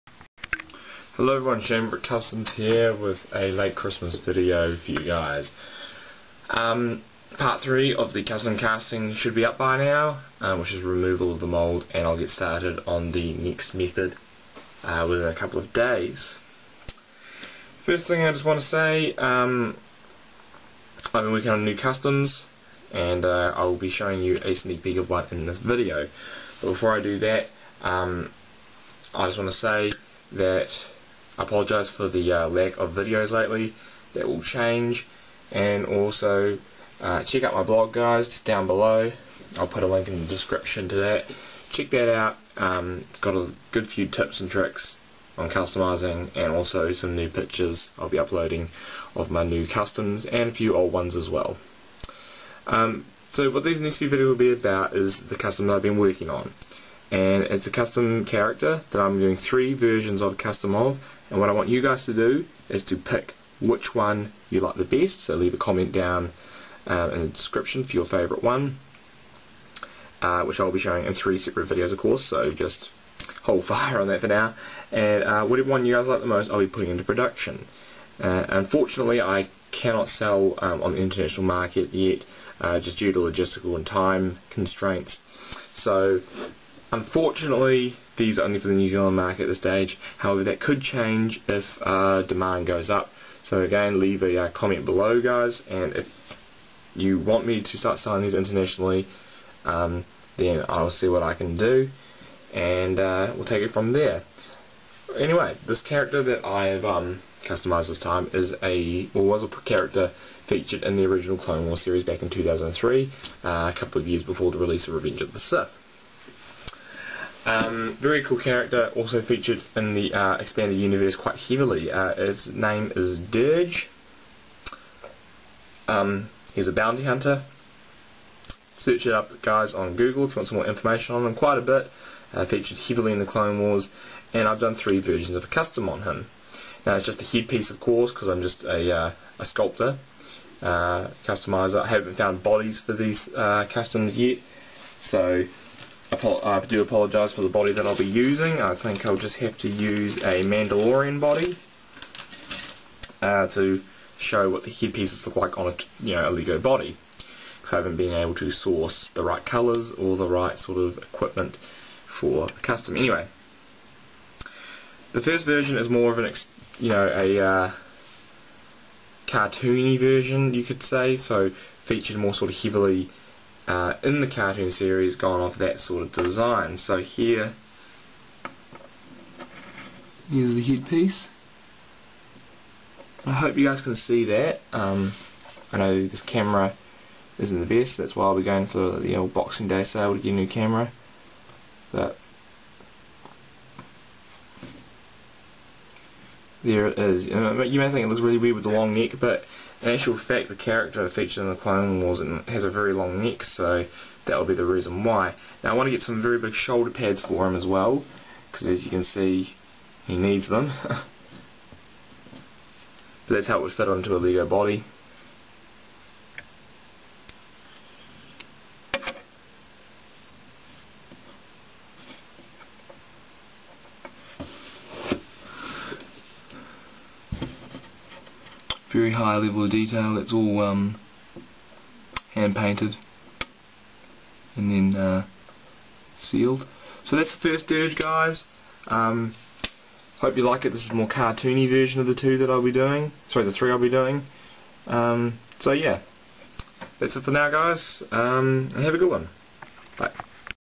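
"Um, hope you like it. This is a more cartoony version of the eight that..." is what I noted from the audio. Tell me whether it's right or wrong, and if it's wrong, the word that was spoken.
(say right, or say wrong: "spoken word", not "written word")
wrong: "two", not "eight".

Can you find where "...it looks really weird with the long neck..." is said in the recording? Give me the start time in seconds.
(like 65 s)
198 s.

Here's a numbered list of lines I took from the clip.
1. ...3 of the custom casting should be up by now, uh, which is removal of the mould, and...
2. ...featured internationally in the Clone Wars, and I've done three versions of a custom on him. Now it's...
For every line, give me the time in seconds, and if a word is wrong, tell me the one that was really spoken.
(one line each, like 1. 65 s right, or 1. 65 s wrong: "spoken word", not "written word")
1. 7 s right
2. 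132 s wrong: "heavily", not "internationally".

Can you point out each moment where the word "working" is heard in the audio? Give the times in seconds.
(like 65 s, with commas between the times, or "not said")
21 s, 55 s.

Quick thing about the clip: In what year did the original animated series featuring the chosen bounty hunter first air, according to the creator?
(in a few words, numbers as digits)
2003.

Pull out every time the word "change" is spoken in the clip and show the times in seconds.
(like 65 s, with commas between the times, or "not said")
34 s, 90 s.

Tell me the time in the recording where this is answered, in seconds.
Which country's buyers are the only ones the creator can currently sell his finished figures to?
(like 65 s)
88 s.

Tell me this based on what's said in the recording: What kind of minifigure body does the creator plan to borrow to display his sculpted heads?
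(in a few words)
Mandalorian body.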